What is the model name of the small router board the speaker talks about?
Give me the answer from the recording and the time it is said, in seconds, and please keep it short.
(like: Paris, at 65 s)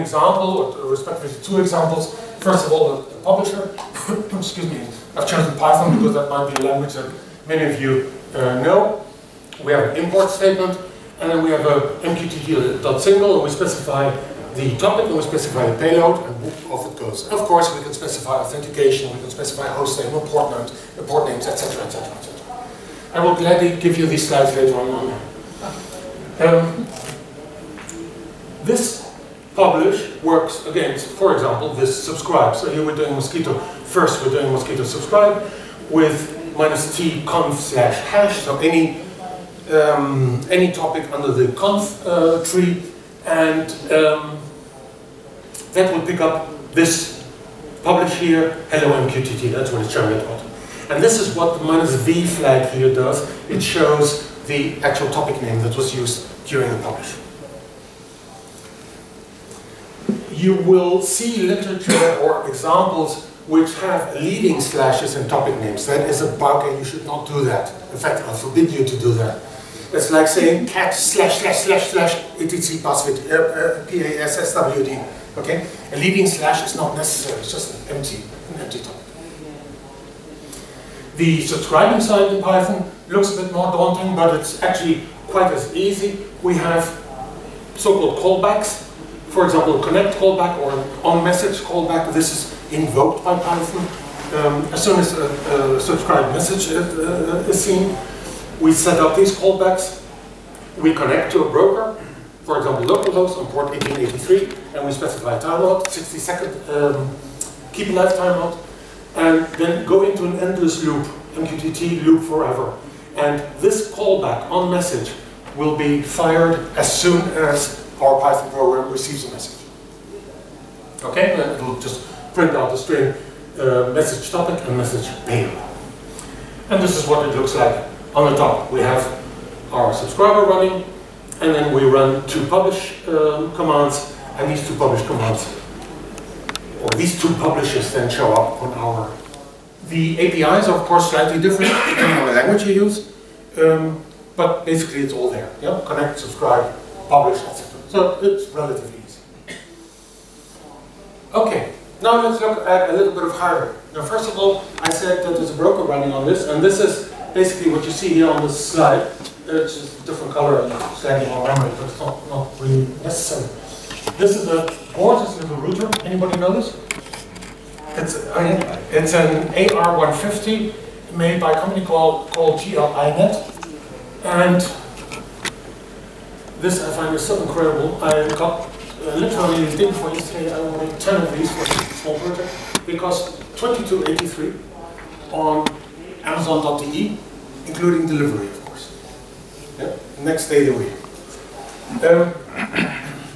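AR150, at 169 s.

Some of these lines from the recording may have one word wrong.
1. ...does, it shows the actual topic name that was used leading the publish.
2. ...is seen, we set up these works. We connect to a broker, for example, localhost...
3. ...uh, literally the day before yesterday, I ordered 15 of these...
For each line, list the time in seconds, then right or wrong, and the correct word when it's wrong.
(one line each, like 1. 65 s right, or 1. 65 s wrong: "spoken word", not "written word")
1. 52 s wrong: "during", not "leading"
2. 97 s wrong: "callbacks", not "works"
3. 179 s wrong: "10", not "15".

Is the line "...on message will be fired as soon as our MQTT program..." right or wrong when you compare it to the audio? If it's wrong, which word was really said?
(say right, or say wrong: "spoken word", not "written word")
wrong: "Python", not "MQTT".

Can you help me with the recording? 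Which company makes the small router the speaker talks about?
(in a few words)
GL.iNet.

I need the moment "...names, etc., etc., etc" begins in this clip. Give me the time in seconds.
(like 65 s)
21 s.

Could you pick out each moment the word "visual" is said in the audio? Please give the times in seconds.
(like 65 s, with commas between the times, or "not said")
not said.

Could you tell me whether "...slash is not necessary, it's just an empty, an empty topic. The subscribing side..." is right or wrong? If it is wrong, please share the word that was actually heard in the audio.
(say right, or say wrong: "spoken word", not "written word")
right.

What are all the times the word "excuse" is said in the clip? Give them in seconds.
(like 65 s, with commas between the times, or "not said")
4 s.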